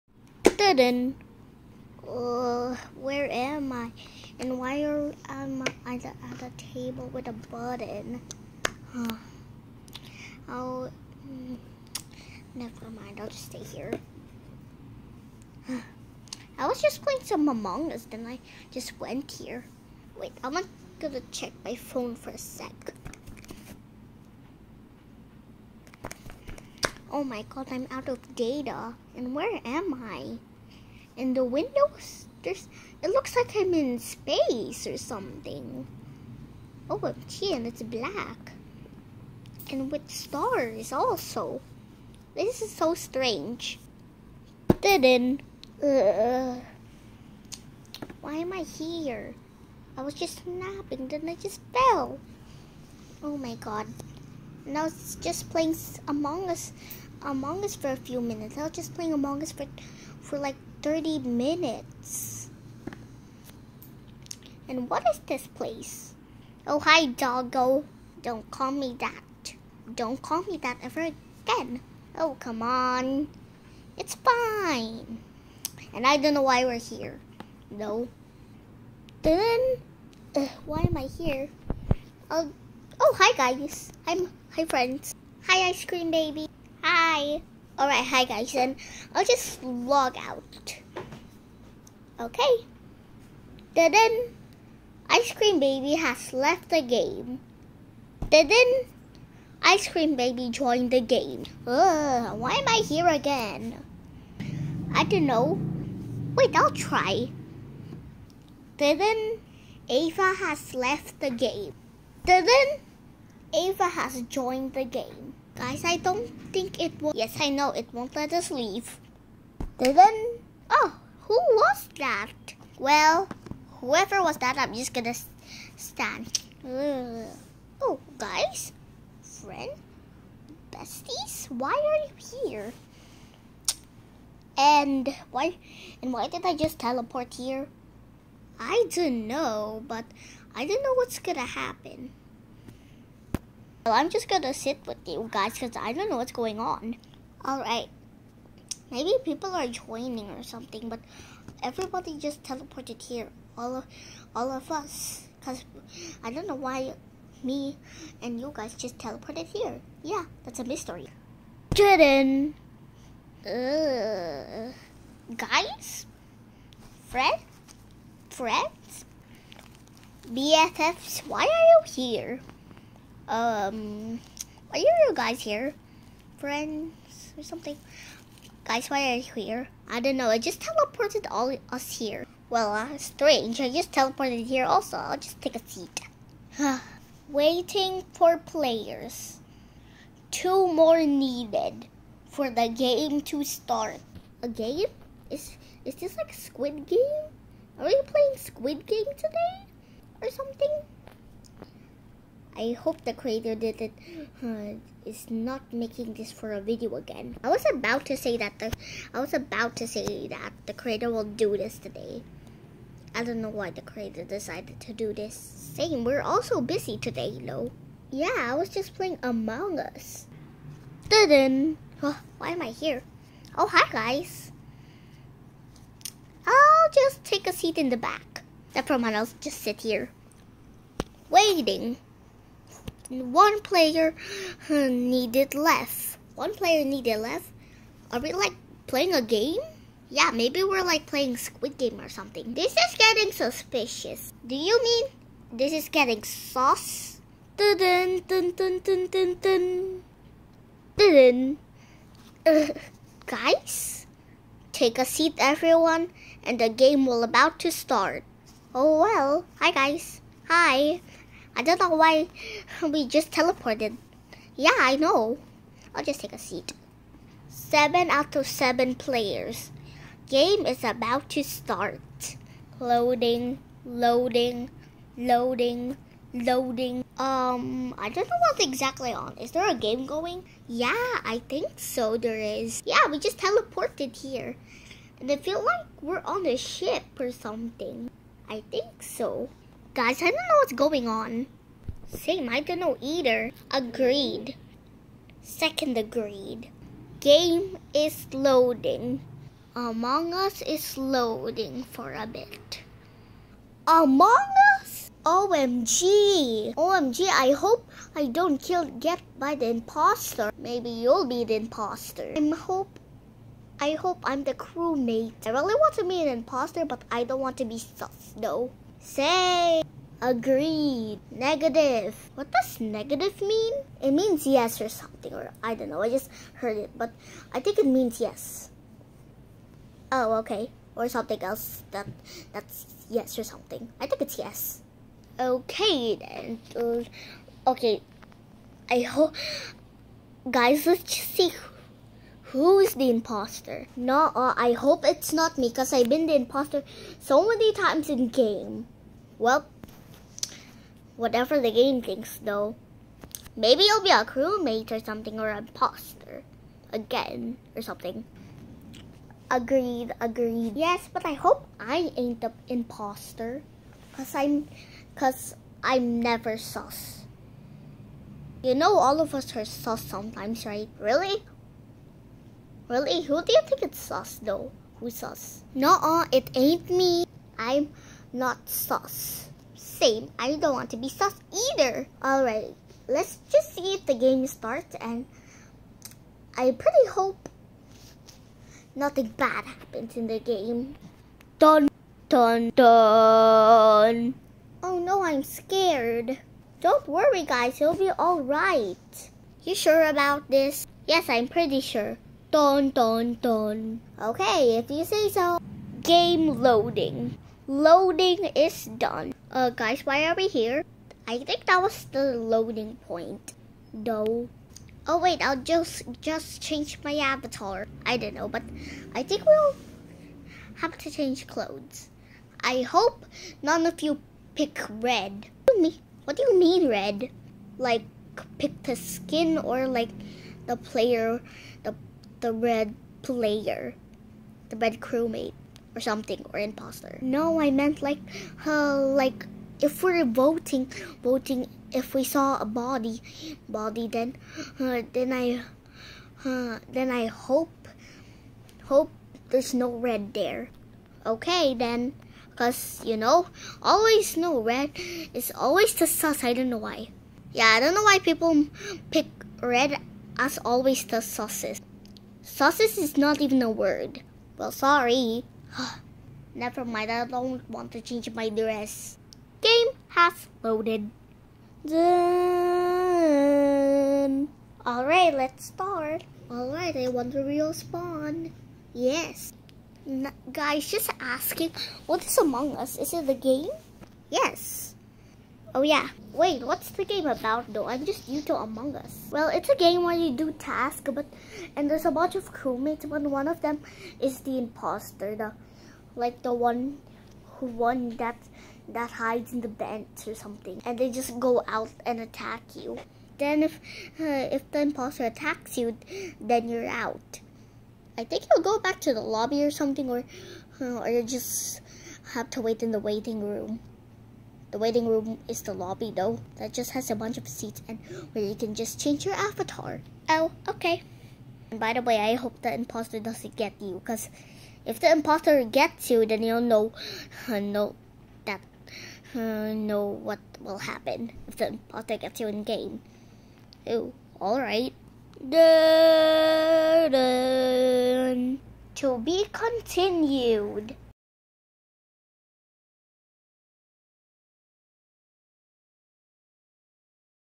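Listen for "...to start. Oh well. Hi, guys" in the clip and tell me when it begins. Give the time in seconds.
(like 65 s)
257 s.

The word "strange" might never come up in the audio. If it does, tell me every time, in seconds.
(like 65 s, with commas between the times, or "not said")
42 s, 182 s.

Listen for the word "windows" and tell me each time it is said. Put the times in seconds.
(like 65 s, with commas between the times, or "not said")
31 s.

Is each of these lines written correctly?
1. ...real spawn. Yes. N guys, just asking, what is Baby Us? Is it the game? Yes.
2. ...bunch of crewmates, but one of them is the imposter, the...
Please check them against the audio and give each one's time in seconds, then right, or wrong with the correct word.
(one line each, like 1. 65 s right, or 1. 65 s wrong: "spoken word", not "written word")
1. 477 s wrong: "Among", not "Baby"
2. 492 s right.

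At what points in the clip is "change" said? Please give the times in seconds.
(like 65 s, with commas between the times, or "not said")
416 s, 421 s, 468 s, 519 s.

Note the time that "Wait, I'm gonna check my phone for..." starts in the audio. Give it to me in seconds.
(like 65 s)
20 s.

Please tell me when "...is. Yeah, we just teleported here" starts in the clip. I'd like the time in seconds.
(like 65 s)
282 s.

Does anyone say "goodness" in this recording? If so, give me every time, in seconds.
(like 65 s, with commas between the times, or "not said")
not said.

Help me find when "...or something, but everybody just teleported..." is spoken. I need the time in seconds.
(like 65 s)
150 s.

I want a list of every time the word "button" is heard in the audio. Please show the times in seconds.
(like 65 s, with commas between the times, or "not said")
7 s.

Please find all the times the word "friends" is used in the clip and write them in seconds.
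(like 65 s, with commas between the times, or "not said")
84 s, 129 s, 168 s, 176 s.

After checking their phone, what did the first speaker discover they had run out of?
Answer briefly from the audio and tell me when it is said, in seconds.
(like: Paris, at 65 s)
Data, at 27 s.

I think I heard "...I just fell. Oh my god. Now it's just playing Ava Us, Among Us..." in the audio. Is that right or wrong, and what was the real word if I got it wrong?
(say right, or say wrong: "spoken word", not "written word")
wrong: "Among", not "Ava".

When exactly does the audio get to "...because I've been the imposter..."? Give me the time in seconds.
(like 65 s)
345 s.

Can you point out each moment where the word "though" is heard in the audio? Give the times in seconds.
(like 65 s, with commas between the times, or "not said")
318 s, 352 s, 374 s, 487 s, 516 s.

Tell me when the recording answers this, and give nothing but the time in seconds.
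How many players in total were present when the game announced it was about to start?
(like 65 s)
267 s.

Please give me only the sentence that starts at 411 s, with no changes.
I think that was the loading point.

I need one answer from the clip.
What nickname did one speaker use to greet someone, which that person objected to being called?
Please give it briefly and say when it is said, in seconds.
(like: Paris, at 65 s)
Doggo, at 66 s.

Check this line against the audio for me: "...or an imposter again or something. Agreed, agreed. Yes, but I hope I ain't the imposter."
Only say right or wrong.
right.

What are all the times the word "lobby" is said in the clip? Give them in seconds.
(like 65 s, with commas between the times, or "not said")
509 s, 515 s.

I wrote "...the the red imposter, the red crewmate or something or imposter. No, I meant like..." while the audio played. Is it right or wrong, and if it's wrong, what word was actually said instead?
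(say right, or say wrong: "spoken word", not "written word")
wrong: "player", not "imposter".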